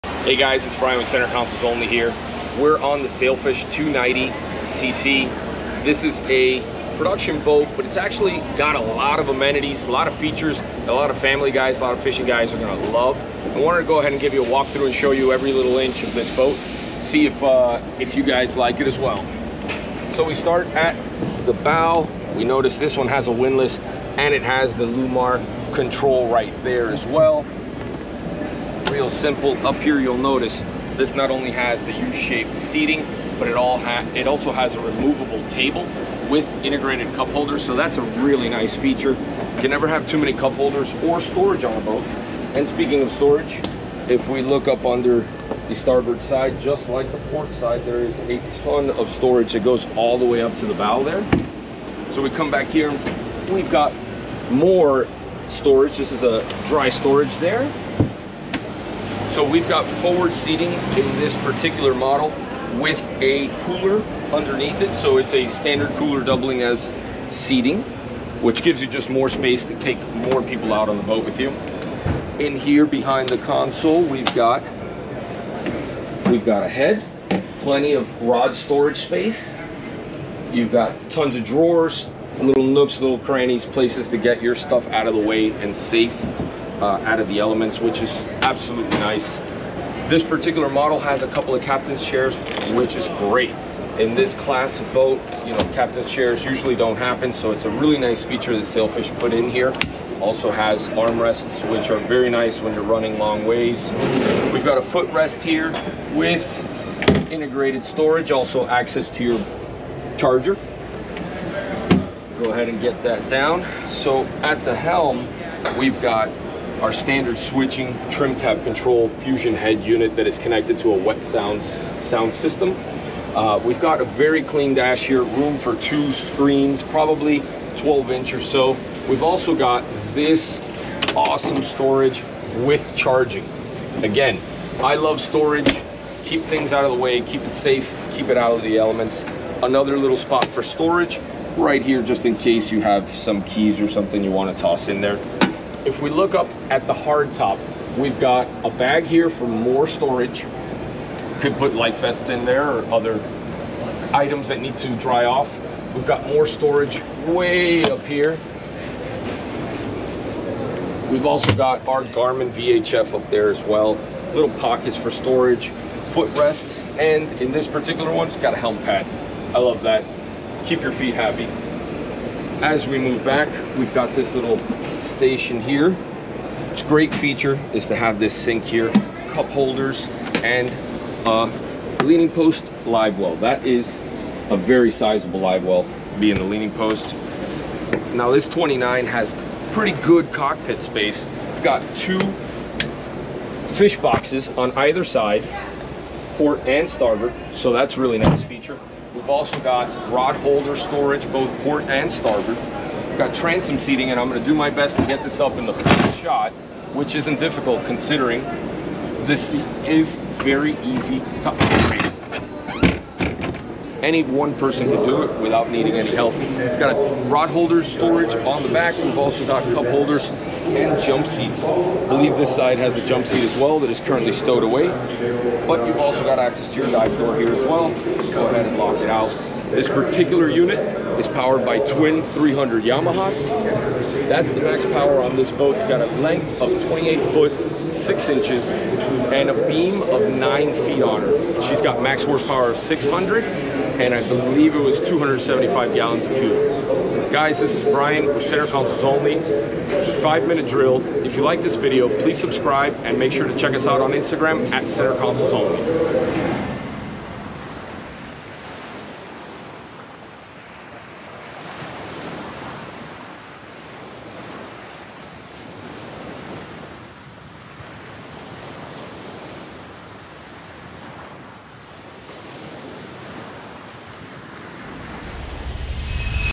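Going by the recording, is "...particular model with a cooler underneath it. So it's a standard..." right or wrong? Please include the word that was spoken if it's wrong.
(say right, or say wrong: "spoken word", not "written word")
right.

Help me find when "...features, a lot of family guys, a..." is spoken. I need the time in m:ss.
0:10.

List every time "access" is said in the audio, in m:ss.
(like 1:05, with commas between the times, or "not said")
1:48, 3:46.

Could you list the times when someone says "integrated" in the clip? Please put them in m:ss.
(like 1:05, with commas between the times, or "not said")
0:36, 1:47.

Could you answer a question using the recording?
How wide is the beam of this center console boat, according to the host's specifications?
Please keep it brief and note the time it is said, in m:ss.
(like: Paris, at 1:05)
9 feet, at 4:00.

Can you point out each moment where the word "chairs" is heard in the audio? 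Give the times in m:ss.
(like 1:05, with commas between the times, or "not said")
1:32, 1:36.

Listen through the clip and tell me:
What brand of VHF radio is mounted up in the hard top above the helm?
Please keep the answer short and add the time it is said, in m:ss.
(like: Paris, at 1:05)
Garmin, at 2:42.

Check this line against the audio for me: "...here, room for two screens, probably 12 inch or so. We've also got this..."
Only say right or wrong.
right.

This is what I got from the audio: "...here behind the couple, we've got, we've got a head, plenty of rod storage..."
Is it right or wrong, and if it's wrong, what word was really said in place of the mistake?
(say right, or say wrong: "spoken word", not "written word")
wrong: "console", not "couple".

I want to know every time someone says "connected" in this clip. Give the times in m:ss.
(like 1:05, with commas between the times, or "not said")
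2:00.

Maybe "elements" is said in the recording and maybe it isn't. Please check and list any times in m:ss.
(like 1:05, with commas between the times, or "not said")
1:27, 2:18.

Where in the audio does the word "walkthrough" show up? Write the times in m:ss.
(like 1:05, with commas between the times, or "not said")
0:14.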